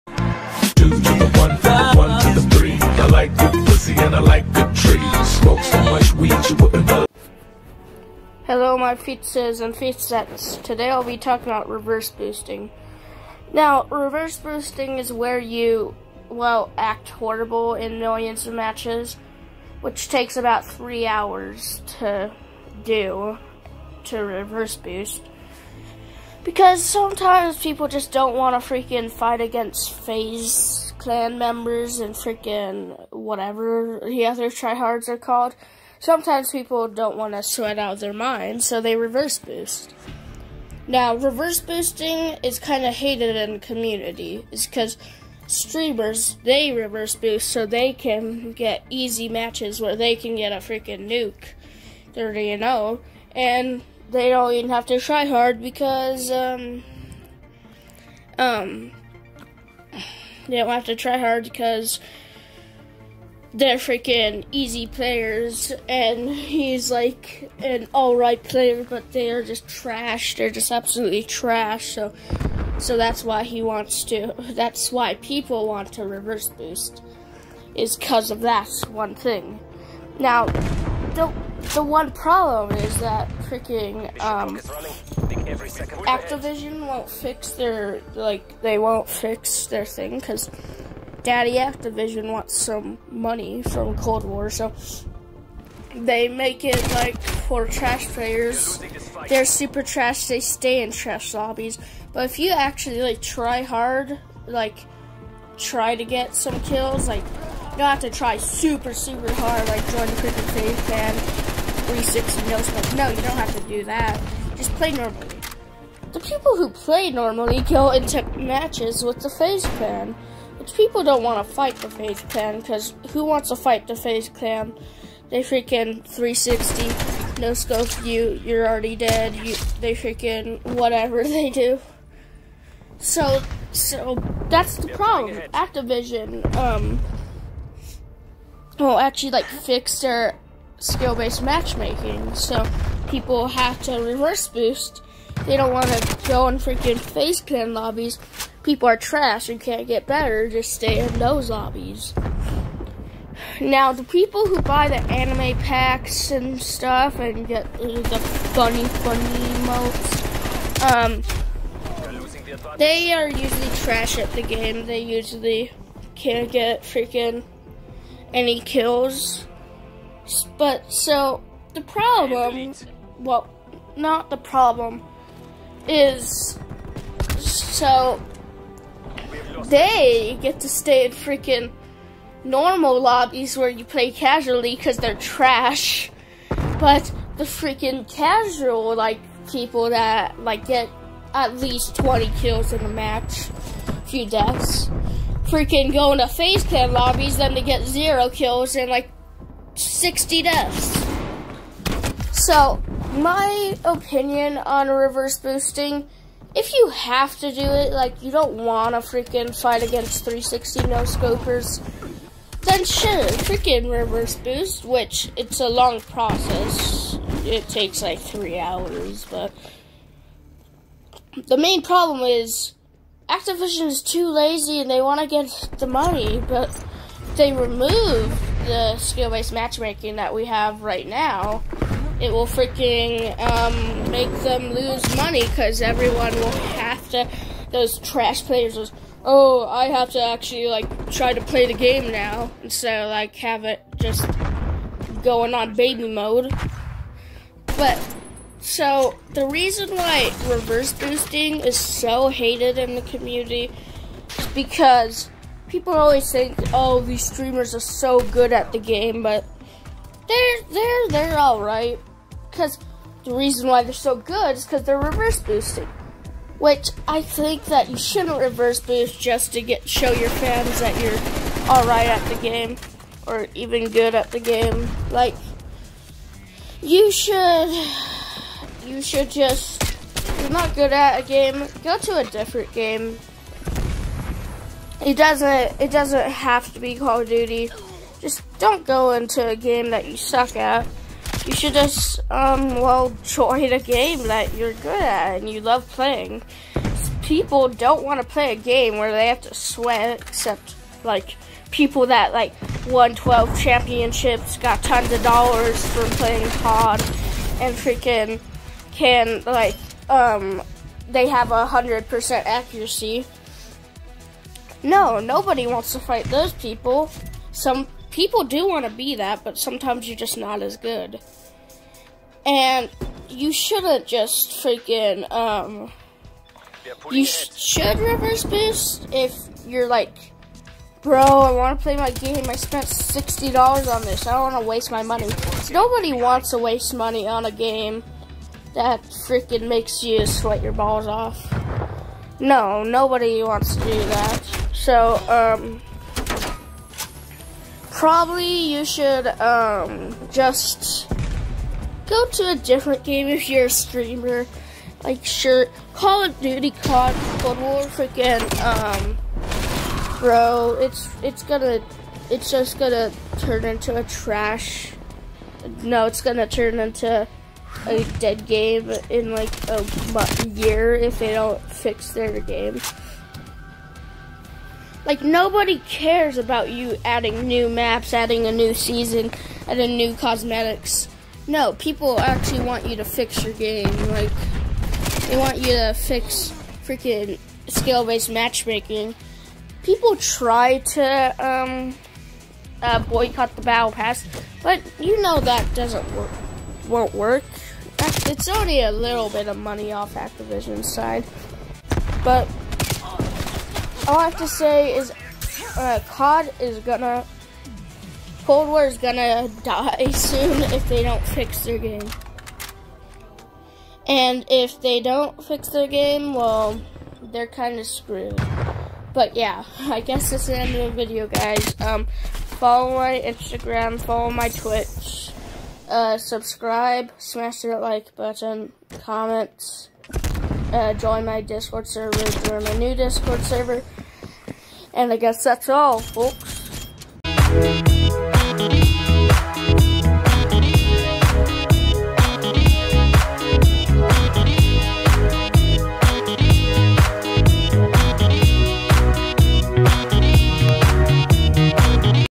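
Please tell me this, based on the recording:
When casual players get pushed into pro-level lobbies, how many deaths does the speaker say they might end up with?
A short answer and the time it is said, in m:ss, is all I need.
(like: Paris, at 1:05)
60, at 3:19.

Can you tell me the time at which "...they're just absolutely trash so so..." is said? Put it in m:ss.
1:10.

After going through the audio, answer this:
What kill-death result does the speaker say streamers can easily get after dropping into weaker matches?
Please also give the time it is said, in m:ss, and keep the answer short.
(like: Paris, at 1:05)
30 and 0, at 0:52.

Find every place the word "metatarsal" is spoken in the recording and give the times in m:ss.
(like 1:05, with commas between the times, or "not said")
not said.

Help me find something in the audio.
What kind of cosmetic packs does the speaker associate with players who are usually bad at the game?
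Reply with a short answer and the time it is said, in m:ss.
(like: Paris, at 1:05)
anime packs, at 2:35.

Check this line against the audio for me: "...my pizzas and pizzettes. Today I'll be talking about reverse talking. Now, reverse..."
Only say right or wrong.
wrong.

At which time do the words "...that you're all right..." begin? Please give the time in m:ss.
4:30.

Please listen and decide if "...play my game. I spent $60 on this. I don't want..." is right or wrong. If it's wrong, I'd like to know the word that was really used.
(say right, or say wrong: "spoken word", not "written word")
right.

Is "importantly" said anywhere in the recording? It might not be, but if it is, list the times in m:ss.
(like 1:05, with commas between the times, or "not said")
not said.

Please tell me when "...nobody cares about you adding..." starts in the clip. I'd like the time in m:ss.
6:15.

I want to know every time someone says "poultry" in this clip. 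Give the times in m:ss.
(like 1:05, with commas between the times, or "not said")
not said.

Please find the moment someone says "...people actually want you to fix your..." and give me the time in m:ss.
6:21.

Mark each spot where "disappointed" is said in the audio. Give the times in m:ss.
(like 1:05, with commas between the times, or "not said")
not said.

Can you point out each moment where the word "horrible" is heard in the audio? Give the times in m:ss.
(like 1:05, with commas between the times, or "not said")
0:17.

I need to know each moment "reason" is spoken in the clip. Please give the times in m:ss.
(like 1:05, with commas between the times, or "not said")
4:09, 4:23.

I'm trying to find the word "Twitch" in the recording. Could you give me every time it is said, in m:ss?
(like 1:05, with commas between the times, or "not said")
7:04.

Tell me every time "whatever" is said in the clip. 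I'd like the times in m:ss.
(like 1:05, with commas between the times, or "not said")
0:33, 2:10.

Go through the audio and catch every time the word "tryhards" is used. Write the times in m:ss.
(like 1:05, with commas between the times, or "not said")
0:34.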